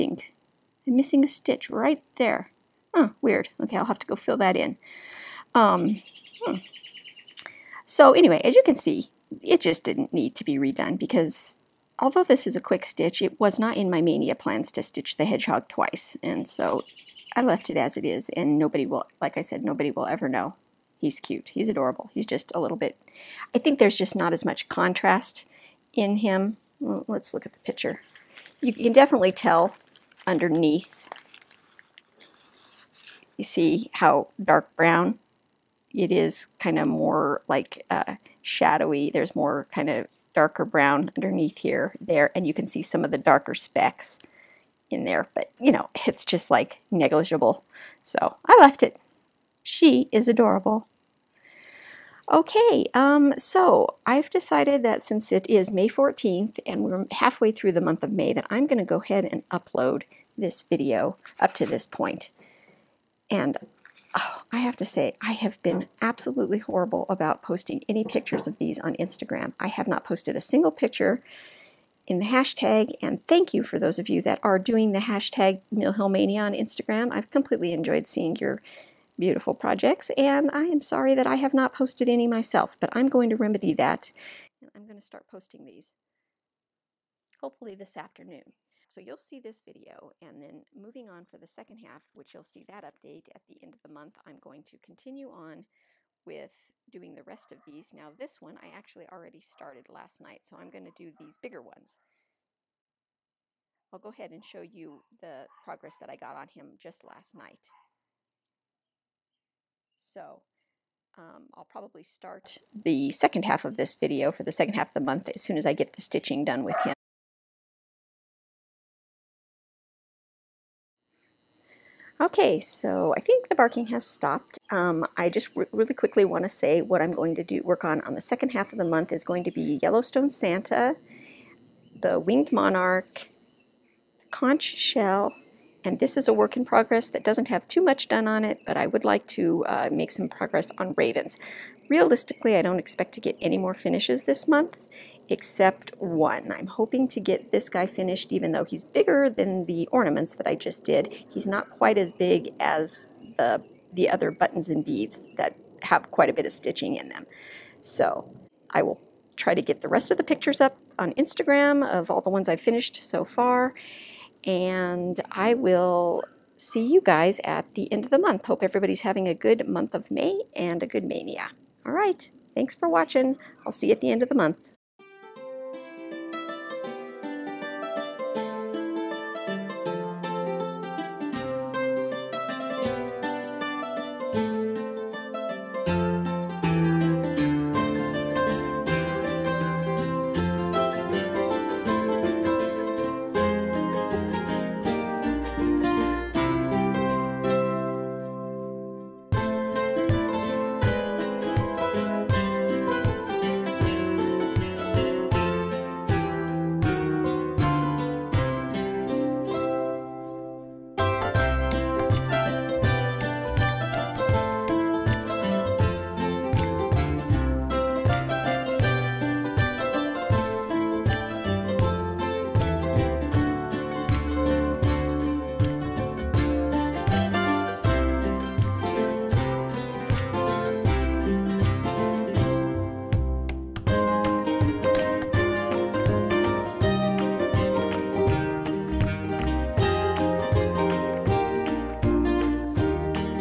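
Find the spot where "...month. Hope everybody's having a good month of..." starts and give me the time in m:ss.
2:48.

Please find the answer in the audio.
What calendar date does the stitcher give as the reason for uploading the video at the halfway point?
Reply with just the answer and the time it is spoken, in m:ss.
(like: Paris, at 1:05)
May 14, at 0:55.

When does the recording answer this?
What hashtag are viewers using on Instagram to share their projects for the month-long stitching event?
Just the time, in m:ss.
1:15.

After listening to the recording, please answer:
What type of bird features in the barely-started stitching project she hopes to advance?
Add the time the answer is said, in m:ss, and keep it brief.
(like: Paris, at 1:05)
Ravens, at 2:20.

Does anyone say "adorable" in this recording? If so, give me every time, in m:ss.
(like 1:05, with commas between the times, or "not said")
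0:21, 0:50.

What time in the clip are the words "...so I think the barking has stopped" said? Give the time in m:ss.
2:02.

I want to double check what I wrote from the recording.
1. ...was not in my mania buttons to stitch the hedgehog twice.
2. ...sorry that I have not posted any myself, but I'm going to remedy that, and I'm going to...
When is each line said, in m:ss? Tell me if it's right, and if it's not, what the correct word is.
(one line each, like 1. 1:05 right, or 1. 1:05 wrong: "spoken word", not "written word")
1. 0:13 wrong: "plans", not "buttons"
2. 1:20 right.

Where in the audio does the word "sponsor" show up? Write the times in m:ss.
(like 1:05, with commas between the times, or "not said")
not said.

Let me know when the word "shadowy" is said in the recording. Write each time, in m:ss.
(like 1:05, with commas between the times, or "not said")
0:38.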